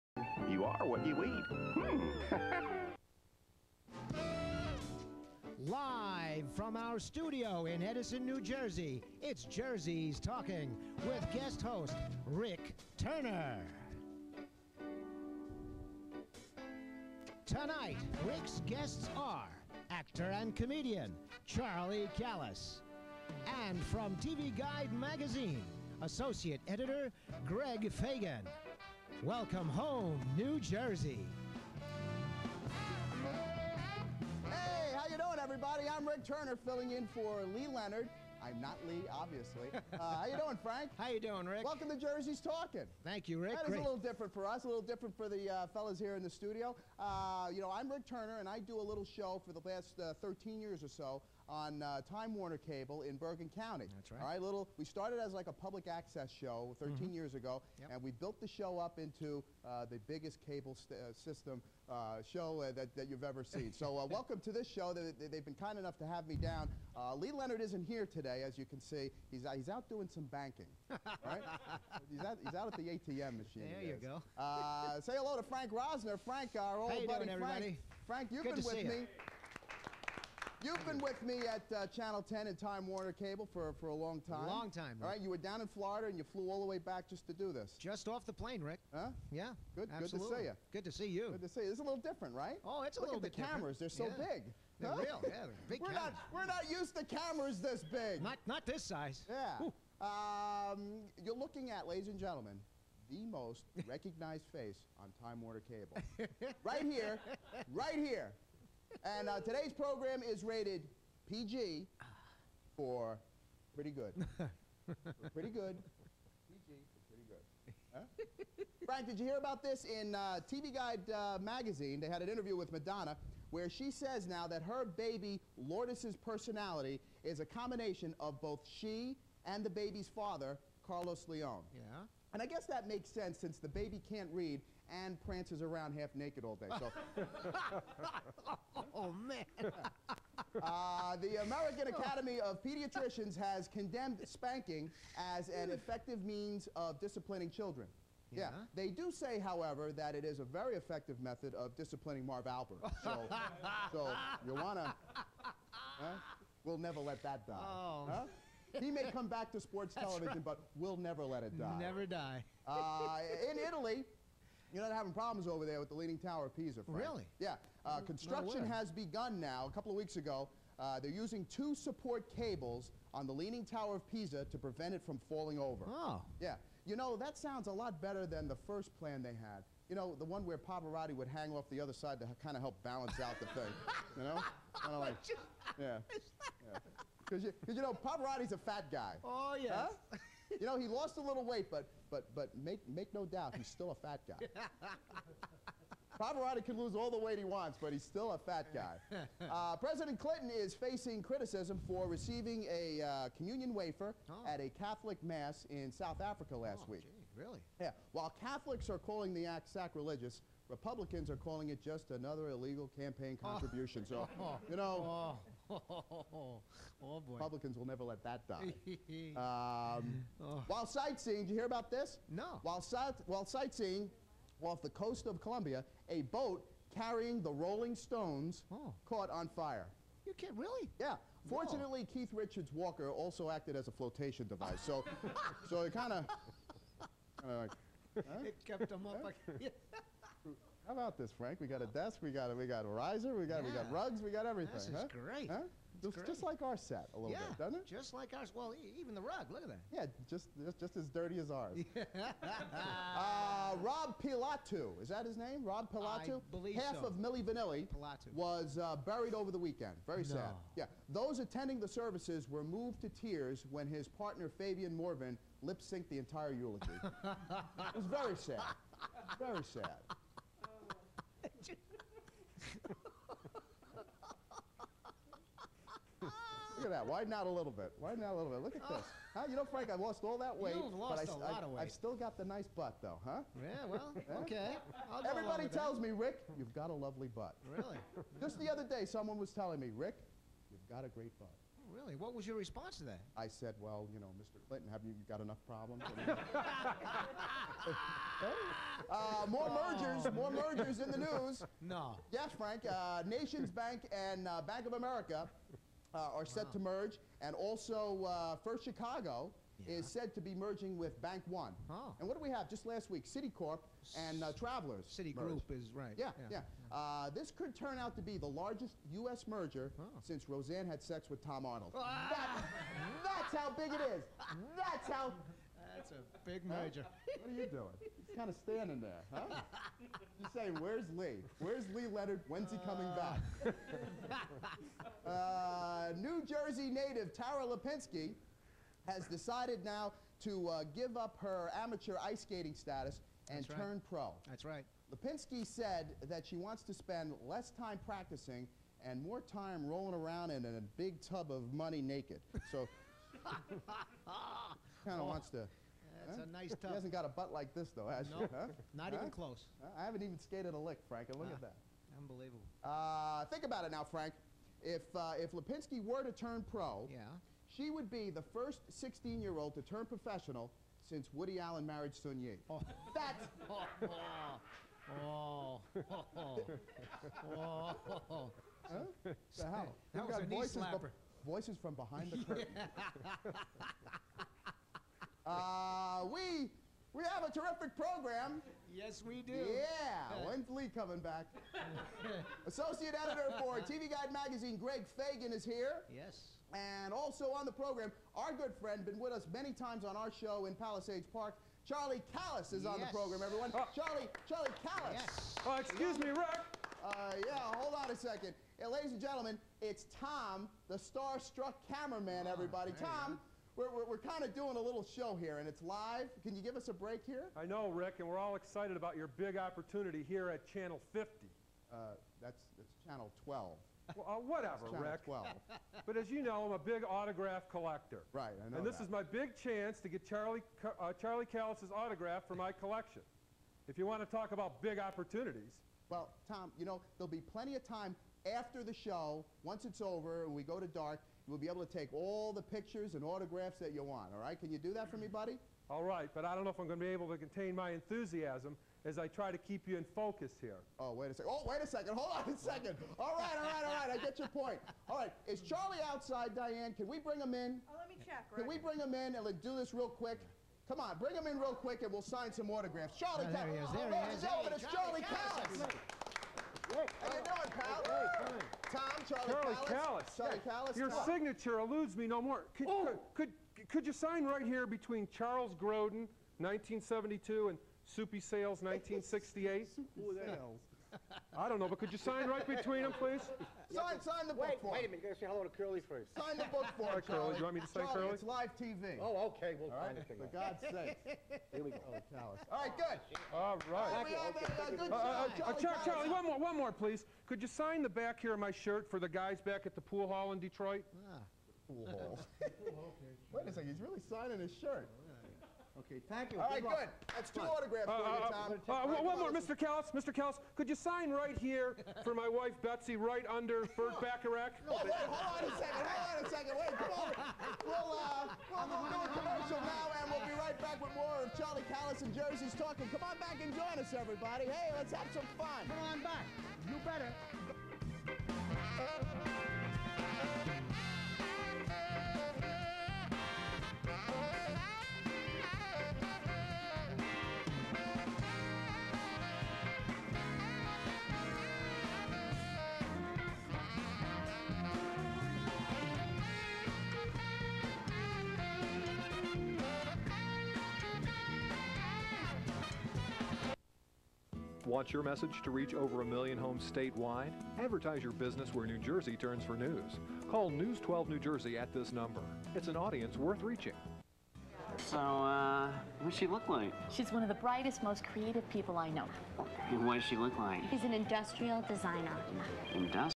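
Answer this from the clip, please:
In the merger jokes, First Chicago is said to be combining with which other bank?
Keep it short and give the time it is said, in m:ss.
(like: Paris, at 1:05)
Bank One, at 5:11.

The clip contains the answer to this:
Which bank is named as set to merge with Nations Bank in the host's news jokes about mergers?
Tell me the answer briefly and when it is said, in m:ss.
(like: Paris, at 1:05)
Bank of America, at 5:04.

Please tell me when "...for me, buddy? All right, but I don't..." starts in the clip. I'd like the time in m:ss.
7:25.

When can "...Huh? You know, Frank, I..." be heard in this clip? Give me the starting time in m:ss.
4:39.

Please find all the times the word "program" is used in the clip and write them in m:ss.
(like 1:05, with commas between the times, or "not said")
1:49, 6:27, 6:37, 6:43.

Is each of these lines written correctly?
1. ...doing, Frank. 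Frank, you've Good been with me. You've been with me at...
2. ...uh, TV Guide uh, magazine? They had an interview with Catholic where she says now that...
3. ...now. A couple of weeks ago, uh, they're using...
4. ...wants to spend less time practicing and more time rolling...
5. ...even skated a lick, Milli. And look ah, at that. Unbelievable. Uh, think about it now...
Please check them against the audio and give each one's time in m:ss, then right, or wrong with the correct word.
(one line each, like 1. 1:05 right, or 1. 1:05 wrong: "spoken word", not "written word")
1. 1:17 right
2. 2:00 wrong: "Madonna", not "Catholic"
3. 2:49 right
4. 5:46 right
5. 6:00 wrong: "Frank", not "Milli".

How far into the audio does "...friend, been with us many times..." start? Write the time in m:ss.
6:38.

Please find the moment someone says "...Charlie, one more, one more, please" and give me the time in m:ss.
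8:16.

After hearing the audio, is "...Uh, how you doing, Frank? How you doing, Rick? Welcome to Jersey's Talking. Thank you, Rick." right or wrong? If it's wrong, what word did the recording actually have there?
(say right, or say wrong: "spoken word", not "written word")
right.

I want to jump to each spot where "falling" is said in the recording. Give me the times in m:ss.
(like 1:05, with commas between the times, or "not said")
2:55.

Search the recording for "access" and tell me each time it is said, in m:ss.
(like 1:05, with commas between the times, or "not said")
0:55.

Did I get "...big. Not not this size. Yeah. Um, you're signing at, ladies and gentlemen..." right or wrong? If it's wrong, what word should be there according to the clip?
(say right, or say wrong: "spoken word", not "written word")
wrong: "looking", not "signing".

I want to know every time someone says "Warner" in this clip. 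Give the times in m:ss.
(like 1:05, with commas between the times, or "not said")
0:52, 1:22, 1:45.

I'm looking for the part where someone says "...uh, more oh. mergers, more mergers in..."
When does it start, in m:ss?
4:59.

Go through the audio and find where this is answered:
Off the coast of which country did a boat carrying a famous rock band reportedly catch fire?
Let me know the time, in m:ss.
3:45.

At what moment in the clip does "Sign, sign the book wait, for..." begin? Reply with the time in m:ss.
8:03.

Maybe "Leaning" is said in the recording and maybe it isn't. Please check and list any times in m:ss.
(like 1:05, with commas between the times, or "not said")
2:45, 2:53.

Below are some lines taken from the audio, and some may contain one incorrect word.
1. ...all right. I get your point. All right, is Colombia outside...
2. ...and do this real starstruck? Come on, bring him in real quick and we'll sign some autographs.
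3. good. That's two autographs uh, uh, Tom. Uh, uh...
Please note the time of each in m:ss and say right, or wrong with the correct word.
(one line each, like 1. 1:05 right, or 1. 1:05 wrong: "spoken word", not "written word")
1. 7:33 wrong: "Charlie", not "Colombia"
2. 7:39 wrong: "quick", not "starstruck"
3. 8:26 right.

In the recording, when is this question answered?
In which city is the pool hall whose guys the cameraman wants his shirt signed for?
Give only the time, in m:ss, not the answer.
8:20.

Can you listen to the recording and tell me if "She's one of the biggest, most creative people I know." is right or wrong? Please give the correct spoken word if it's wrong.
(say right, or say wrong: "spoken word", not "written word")
wrong: "brightest", not "biggest".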